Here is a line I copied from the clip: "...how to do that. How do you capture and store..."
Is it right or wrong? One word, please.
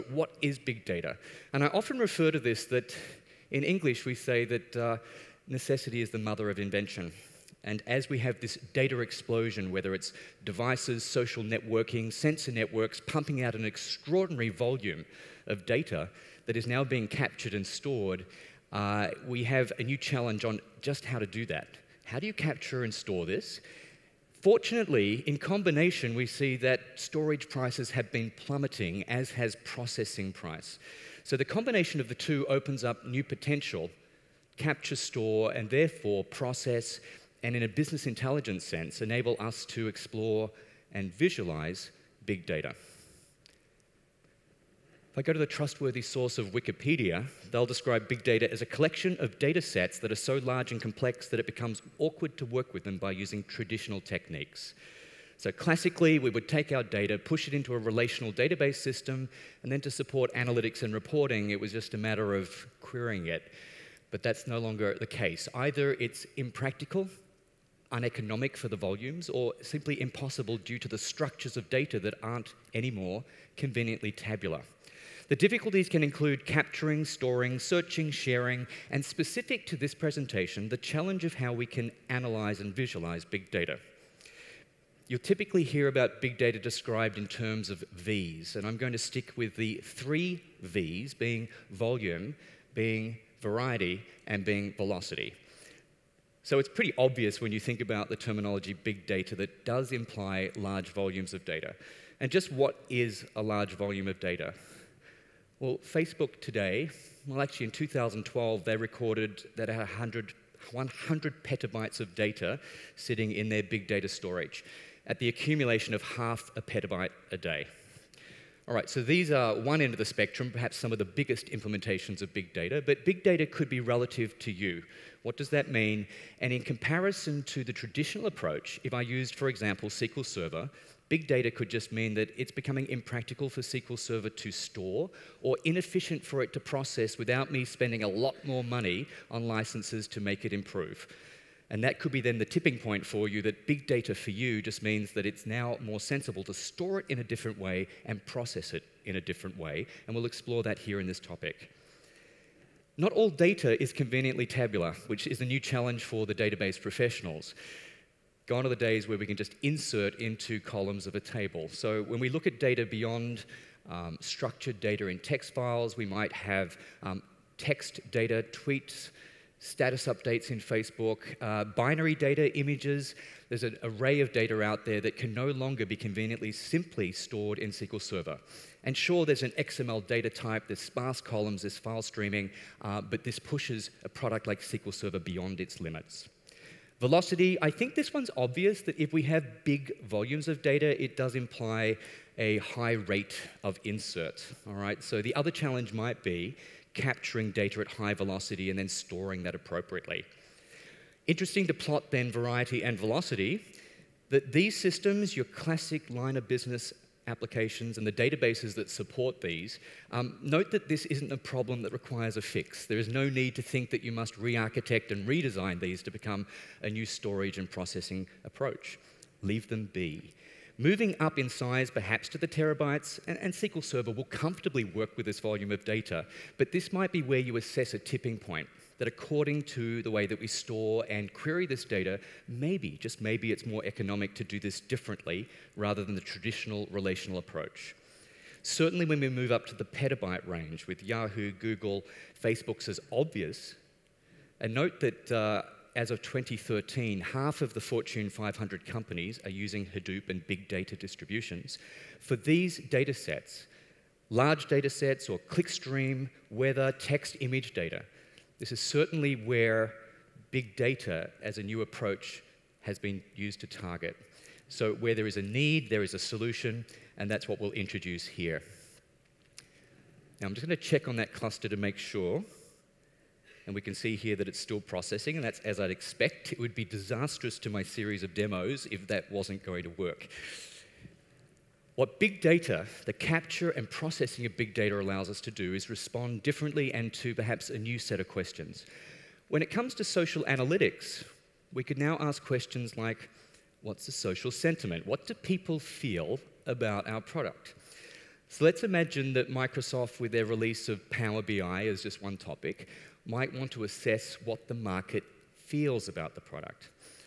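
right.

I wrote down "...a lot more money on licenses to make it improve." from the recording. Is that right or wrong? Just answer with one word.
right.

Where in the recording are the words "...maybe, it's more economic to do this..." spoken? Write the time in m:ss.
3:53.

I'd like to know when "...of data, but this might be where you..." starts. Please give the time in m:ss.
3:45.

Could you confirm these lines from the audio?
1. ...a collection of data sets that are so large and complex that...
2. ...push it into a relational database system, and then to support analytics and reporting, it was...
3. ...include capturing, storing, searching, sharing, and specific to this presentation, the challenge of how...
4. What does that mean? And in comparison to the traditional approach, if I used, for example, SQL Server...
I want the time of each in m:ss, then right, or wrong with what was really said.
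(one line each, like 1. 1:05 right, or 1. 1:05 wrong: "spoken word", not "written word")
1. 0:48 right
2. 0:57 right
3. 1:16 right
4. 2:05 right.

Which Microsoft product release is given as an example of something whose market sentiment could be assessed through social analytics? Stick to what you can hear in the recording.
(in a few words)
Power BI.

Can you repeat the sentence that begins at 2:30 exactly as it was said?
And we'll explore that here in this topic.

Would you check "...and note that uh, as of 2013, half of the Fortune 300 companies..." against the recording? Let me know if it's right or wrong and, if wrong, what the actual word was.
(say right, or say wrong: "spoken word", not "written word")
wrong: "500", not "300".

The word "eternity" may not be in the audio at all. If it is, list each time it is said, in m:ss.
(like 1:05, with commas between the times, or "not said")
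not said.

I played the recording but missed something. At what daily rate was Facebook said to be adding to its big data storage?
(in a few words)
half a petabyte a day.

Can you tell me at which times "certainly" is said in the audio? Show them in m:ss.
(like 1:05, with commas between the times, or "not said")
3:58, 4:18.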